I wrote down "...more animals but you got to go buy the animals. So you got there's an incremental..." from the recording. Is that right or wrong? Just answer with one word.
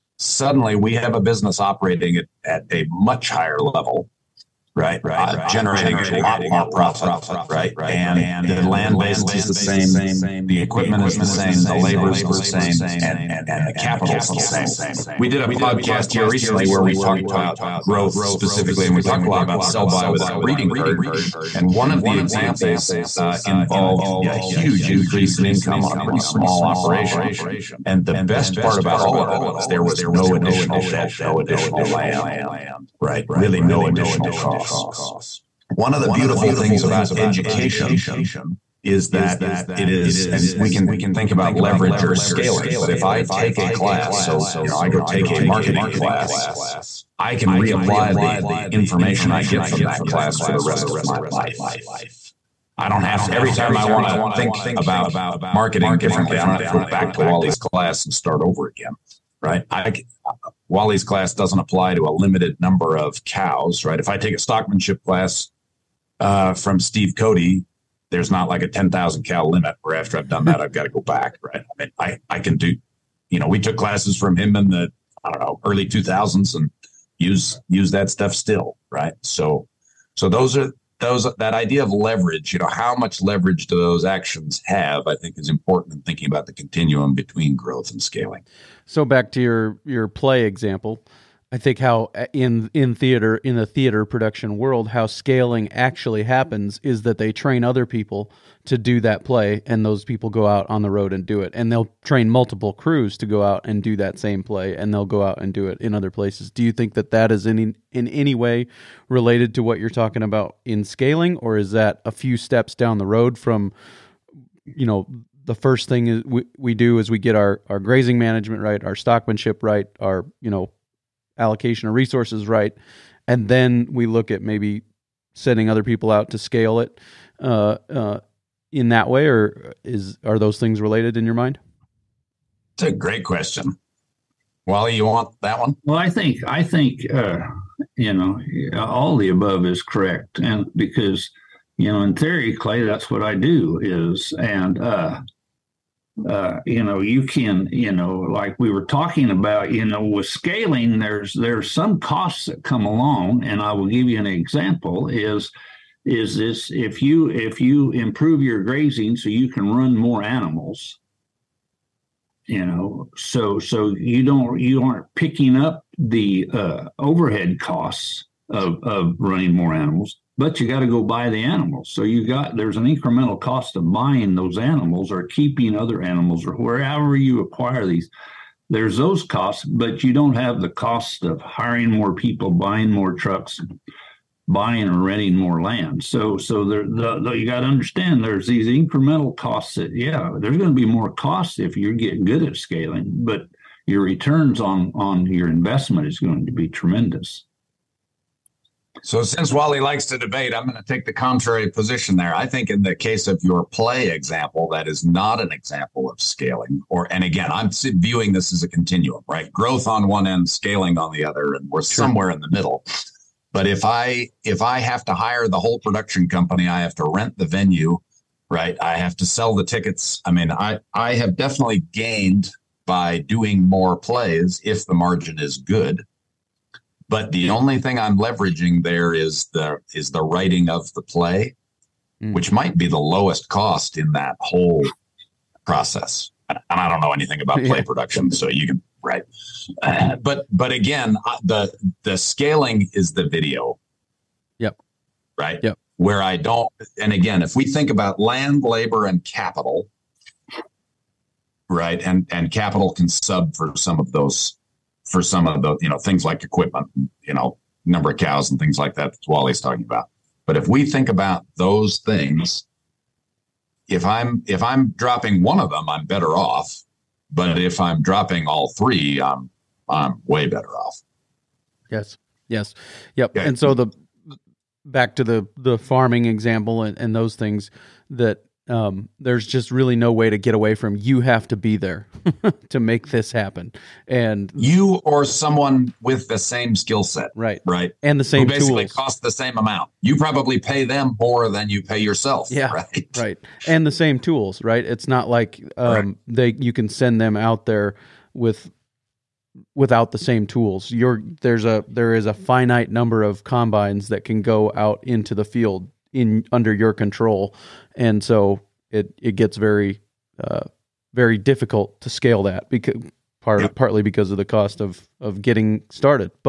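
right.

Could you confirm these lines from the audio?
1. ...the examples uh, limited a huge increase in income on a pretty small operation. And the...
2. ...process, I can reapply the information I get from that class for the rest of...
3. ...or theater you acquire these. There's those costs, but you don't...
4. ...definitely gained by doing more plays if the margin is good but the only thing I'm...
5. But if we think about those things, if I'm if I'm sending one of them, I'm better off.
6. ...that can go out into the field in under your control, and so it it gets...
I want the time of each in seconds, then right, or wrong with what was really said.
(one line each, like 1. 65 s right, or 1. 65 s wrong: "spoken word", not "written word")
1. 22 s wrong: "involved", not "limited"
2. 45 s wrong: "class", not "process"
3. 176 s wrong: "wherever", not "theater"
4. 221 s right
5. 260 s wrong: "dropping", not "sending"
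6. 304 s right.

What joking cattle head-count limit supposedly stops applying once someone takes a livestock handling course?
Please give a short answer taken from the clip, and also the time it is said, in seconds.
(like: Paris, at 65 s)
10,000, at 68 s.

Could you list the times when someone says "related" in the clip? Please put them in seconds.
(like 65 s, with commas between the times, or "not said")
109 s, 130 s.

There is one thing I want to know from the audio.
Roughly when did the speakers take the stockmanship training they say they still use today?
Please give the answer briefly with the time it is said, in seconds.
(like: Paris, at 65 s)
early 2000s, at 75 s.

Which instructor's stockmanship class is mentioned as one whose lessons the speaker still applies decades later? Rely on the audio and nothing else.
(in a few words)
Steve Cote.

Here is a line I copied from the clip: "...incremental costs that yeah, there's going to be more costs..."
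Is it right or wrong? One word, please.
right.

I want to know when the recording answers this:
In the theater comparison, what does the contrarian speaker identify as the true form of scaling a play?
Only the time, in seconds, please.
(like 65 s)
243 s.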